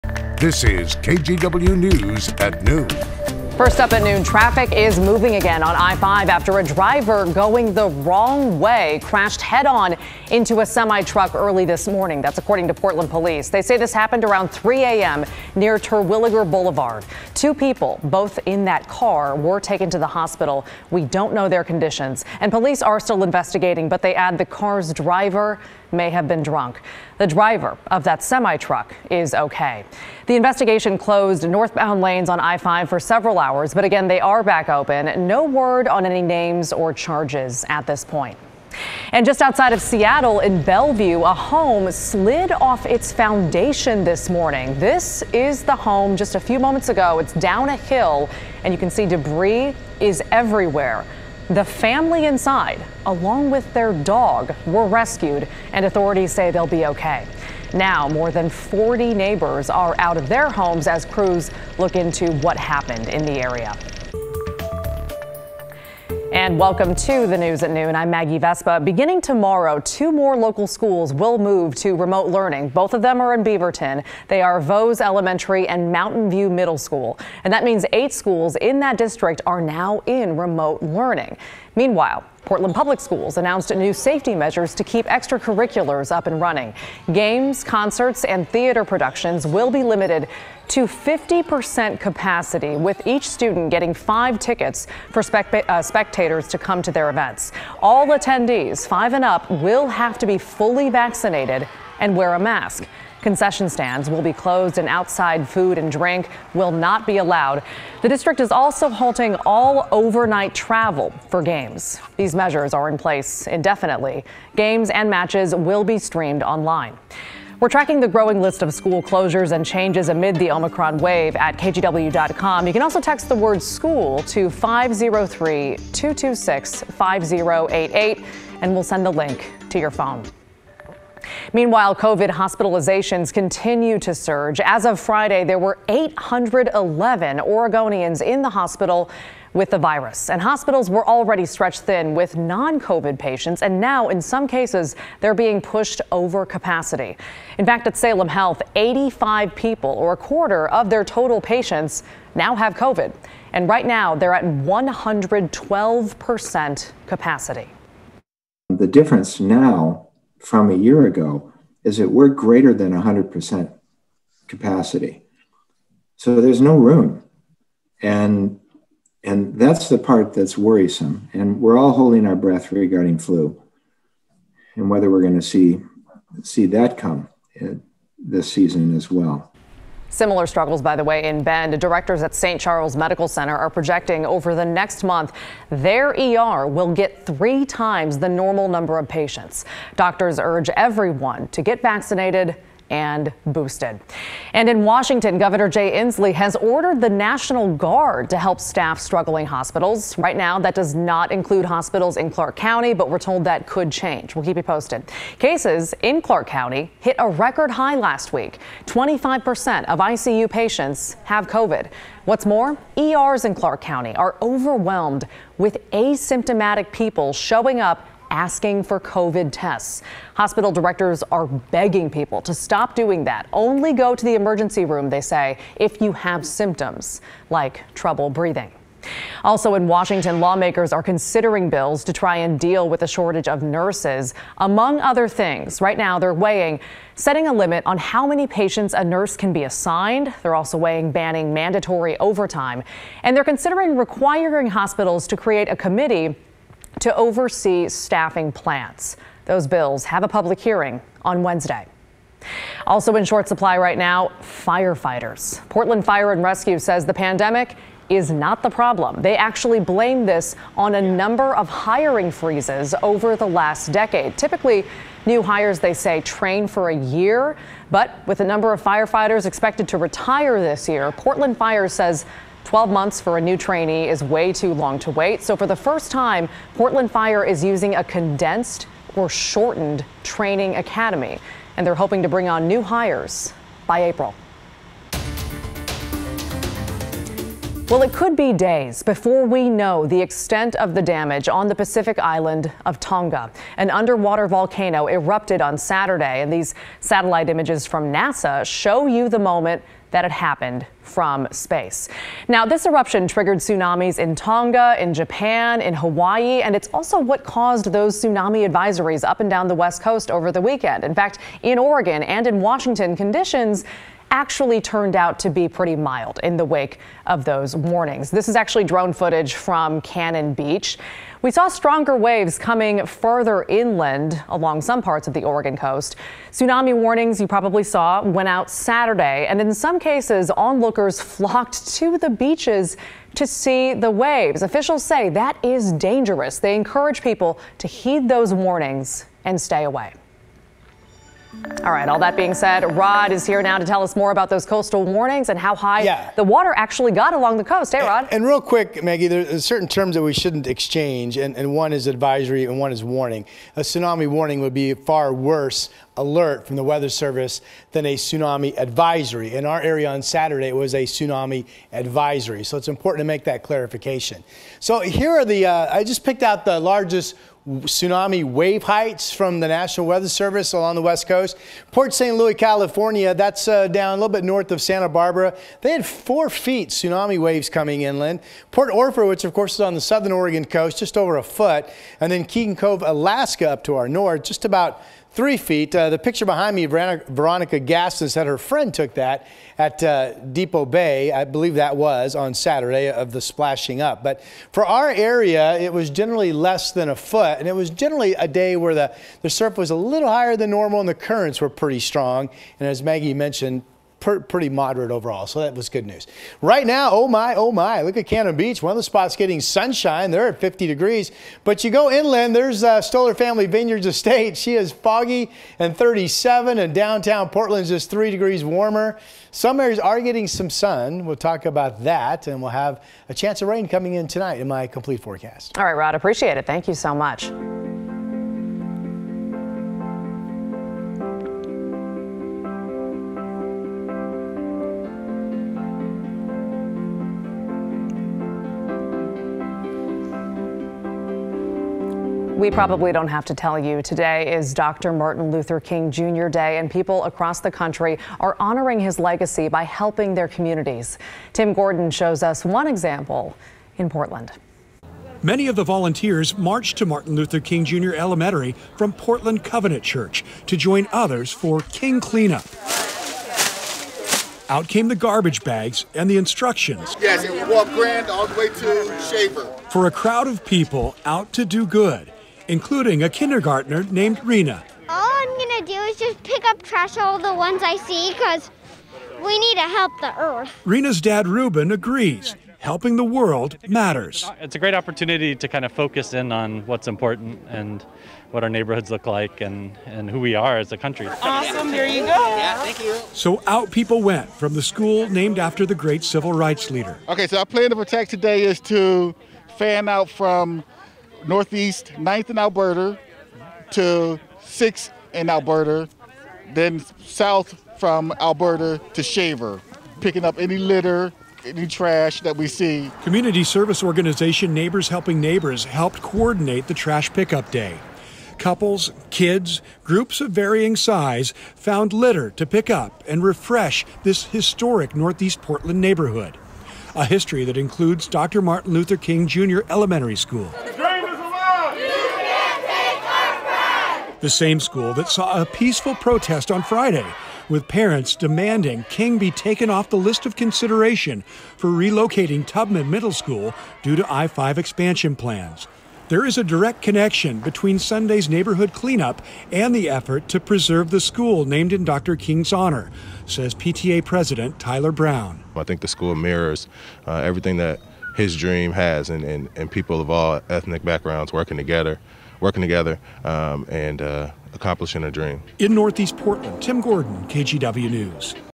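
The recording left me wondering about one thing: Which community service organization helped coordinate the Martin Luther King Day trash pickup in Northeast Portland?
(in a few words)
Neighbors Helping Neighbors.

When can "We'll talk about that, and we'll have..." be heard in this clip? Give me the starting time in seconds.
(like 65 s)
421 s.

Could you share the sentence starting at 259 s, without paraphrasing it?
They actually blame this on a number of hiring freezes over the last decade.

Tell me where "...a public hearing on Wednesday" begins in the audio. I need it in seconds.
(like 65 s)
250 s.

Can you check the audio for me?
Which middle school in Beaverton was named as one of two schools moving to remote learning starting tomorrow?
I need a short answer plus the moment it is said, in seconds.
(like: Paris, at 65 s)
Mountain View Middle School, at 75 s.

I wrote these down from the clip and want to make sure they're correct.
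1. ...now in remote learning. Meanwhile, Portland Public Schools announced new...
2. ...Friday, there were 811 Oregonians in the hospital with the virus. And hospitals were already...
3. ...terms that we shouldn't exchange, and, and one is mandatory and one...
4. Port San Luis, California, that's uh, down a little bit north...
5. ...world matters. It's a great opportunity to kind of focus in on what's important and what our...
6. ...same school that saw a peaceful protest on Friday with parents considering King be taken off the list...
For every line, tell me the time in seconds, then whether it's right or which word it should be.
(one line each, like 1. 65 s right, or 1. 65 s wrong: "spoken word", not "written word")
1. 79 s right
2. 134 s right
3. 349 s wrong: "advisory", not "mandatory"
4. 371 s right
5. 483 s right
6. 534 s wrong: "demanding", not "considering".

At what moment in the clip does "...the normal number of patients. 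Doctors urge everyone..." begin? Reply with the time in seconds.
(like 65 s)
188 s.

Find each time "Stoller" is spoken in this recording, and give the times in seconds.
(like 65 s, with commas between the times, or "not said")
413 s.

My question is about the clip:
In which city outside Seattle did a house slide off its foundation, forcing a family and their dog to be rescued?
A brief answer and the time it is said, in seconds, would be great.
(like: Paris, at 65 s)
Bellevue, at 40 s.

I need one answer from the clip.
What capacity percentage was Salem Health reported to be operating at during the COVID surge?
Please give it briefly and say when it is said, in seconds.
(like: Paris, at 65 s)
112%, at 154 s.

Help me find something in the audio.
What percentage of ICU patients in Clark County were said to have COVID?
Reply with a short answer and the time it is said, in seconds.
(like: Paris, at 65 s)
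25%, at 208 s.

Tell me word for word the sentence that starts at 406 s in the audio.
Right now, oh my, oh my, look at Cannon Beach.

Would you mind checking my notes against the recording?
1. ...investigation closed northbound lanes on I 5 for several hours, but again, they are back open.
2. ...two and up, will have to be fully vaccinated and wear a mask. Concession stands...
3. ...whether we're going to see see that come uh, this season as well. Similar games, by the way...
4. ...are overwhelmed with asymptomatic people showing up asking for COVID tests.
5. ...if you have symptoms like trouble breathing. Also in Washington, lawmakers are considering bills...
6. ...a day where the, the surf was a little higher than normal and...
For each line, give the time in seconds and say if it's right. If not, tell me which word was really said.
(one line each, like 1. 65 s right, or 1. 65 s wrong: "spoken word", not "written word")
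1. 30 s right
2. 98 s wrong: "five", not "two"
3. 174 s wrong: "struggles", not "games"
4. 214 s right
5. 225 s right
6. 398 s right.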